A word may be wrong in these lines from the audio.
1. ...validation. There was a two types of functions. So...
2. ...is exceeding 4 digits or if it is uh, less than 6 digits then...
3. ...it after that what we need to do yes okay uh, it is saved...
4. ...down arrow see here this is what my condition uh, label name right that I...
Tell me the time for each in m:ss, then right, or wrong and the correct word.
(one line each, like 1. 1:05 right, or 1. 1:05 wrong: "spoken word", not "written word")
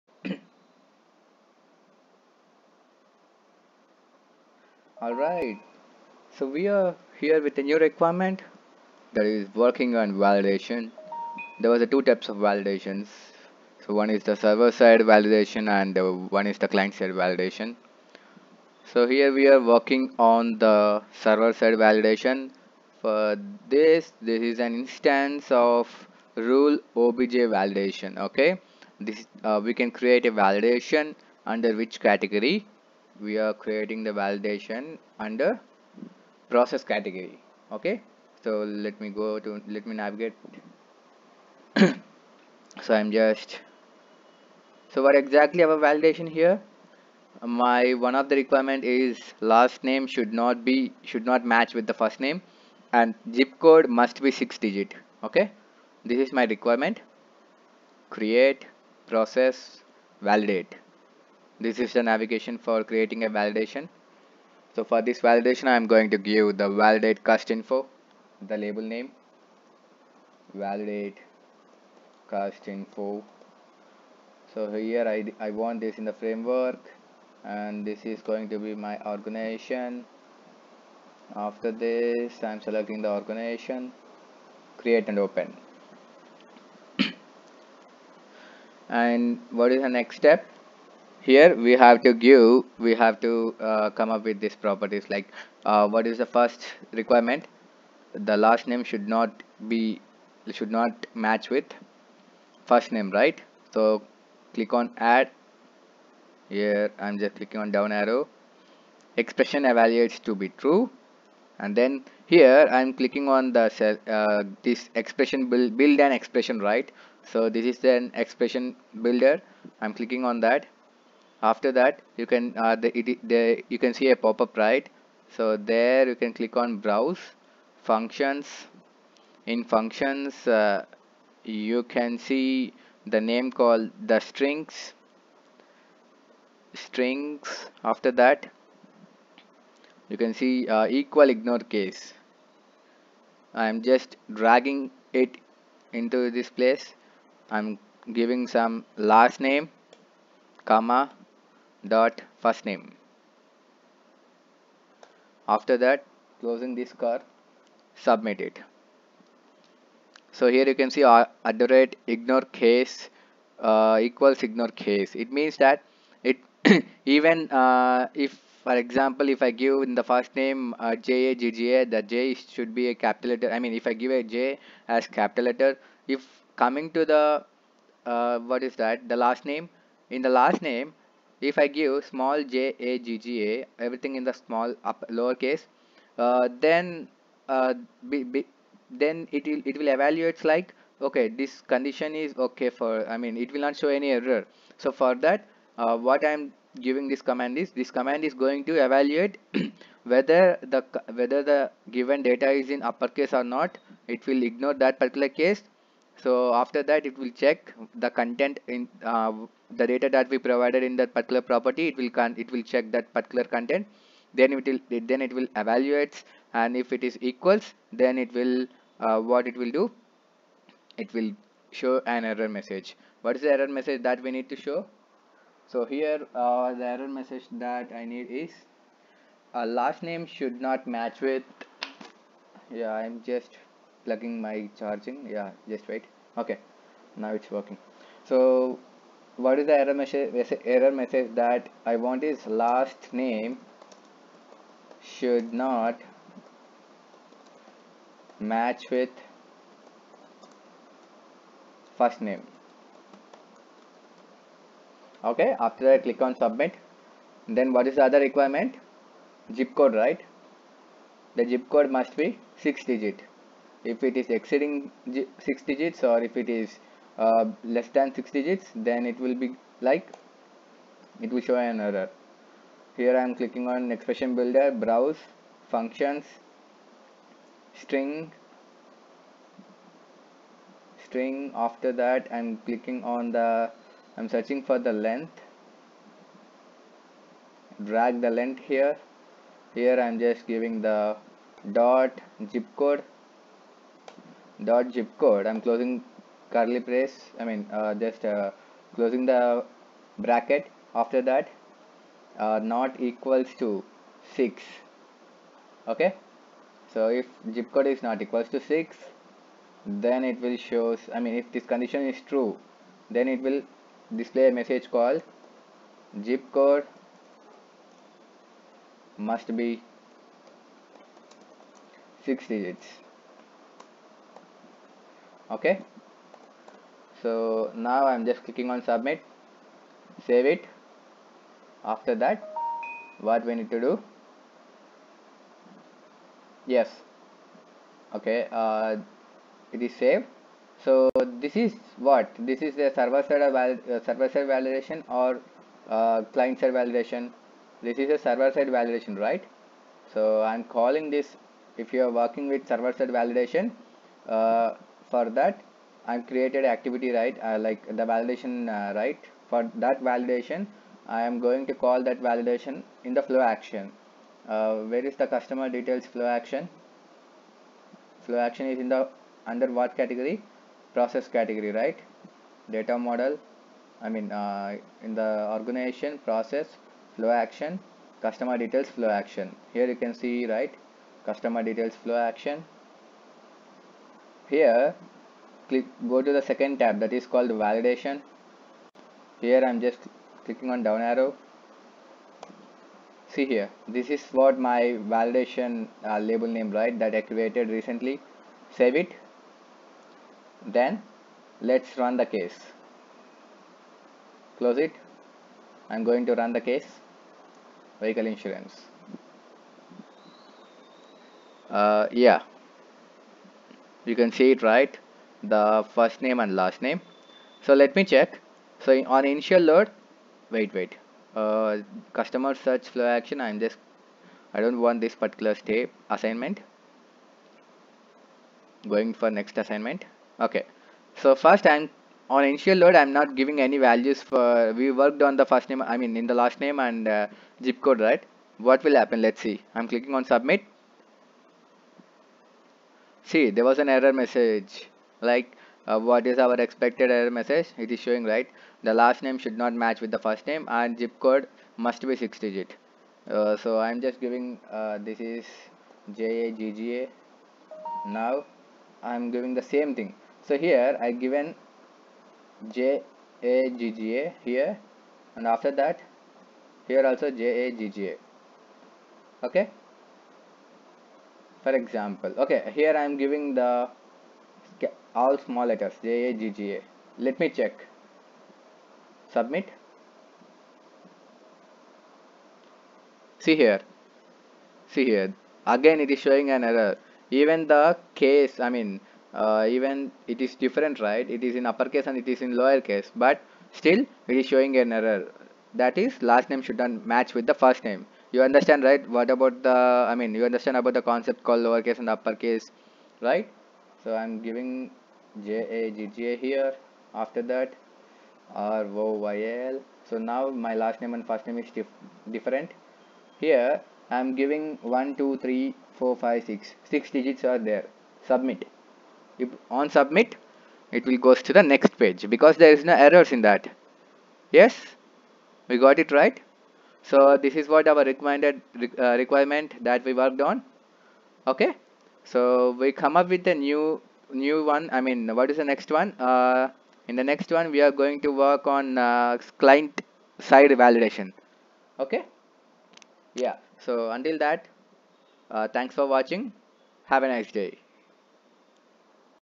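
1. 0:10 wrong: "validations", not "functions"
2. 4:24 wrong: "6", not "4"
3. 5:30 right
4. 6:30 wrong: "validation", not "condition".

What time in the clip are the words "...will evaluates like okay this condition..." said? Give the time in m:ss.
3:09.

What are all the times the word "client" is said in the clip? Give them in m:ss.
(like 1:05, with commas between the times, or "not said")
0:16, 5:46, 8:59.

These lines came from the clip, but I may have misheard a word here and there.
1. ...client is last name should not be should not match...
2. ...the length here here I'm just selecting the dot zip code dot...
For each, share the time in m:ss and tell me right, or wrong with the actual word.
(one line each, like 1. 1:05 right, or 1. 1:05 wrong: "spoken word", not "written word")
1. 0:48 wrong: "requirement", not "client"
2. 4:48 wrong: "giving", not "selecting".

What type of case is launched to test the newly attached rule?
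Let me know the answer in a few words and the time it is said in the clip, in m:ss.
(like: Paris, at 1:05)
vehicle insurance, at 6:48.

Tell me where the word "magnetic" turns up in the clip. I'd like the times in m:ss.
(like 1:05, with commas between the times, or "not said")
not said.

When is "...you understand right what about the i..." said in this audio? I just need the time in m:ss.
8:18.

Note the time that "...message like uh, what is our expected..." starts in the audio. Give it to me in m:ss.
7:24.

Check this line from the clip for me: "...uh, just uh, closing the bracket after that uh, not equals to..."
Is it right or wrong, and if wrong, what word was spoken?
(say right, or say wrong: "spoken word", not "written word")
right.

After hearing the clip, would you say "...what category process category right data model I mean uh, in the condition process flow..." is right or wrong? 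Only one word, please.
wrong.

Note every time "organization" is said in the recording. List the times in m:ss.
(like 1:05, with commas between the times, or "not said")
1:19, 1:23, 6:15.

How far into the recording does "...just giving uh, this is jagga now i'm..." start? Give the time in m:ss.
7:34.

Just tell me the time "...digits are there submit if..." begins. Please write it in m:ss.
8:37.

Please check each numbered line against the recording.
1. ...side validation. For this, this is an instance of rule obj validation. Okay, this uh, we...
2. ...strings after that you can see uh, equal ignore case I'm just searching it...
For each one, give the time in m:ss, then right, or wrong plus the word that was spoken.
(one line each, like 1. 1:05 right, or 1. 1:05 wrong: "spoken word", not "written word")
1. 0:21 right
2. 2:16 wrong: "dragging", not "searching".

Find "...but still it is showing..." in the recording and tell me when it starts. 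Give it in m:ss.
8:13.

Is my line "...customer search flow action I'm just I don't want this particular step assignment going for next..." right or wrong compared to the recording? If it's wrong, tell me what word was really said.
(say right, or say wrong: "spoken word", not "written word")
right.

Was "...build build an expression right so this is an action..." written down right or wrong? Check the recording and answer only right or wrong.
wrong.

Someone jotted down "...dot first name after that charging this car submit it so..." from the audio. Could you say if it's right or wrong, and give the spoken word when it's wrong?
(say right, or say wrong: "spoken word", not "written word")
wrong: "closing", not "charging".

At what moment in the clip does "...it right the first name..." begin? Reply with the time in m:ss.
6:54.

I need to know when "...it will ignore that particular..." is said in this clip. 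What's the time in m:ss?
3:24.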